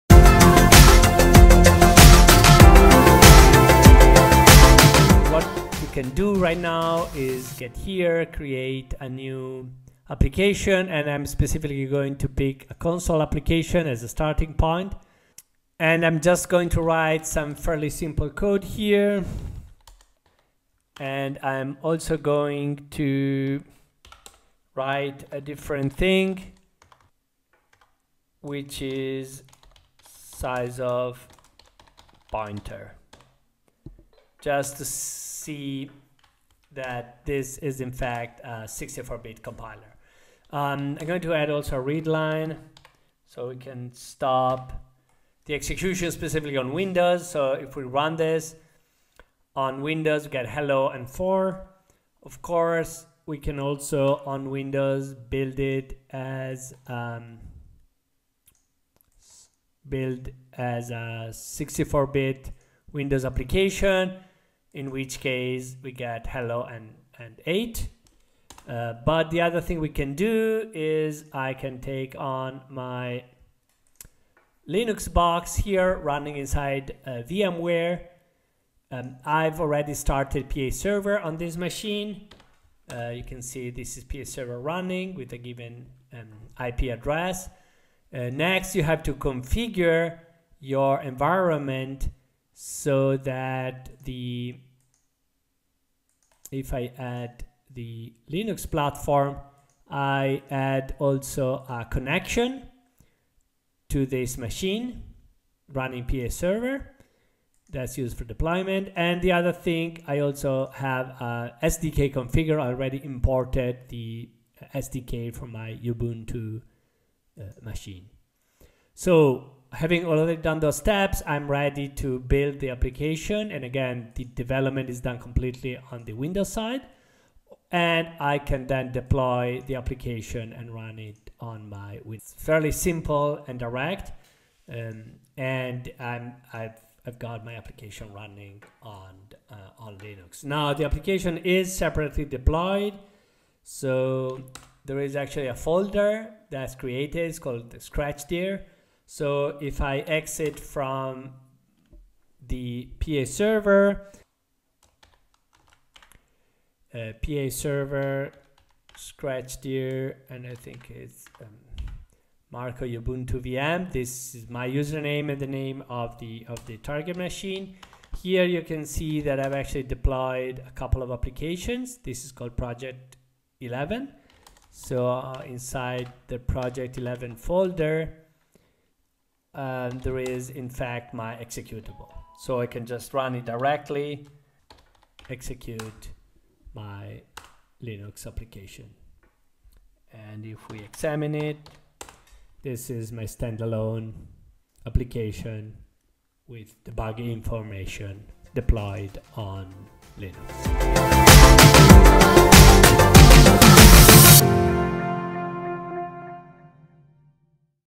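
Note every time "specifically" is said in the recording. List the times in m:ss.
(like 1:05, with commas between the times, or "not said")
0:11, 0:46.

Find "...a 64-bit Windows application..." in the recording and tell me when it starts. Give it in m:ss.
1:00.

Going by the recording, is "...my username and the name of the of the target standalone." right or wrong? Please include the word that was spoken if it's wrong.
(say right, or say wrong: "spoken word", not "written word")
wrong: "machine", not "standalone".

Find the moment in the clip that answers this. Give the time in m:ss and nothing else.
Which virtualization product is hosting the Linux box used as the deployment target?
1:17.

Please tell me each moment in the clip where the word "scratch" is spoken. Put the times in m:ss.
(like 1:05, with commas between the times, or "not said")
2:27, 2:38.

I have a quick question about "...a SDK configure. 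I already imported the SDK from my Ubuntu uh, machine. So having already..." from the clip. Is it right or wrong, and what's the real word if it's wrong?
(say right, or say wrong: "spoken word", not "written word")
right.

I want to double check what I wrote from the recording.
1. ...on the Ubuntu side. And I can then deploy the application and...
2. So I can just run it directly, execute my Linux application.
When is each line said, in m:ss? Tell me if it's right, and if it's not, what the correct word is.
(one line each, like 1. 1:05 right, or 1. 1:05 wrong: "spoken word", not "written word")
1. 2:05 wrong: "Windows", not "Ubuntu"
2. 3:02 right.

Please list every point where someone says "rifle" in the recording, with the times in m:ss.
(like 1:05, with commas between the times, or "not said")
not said.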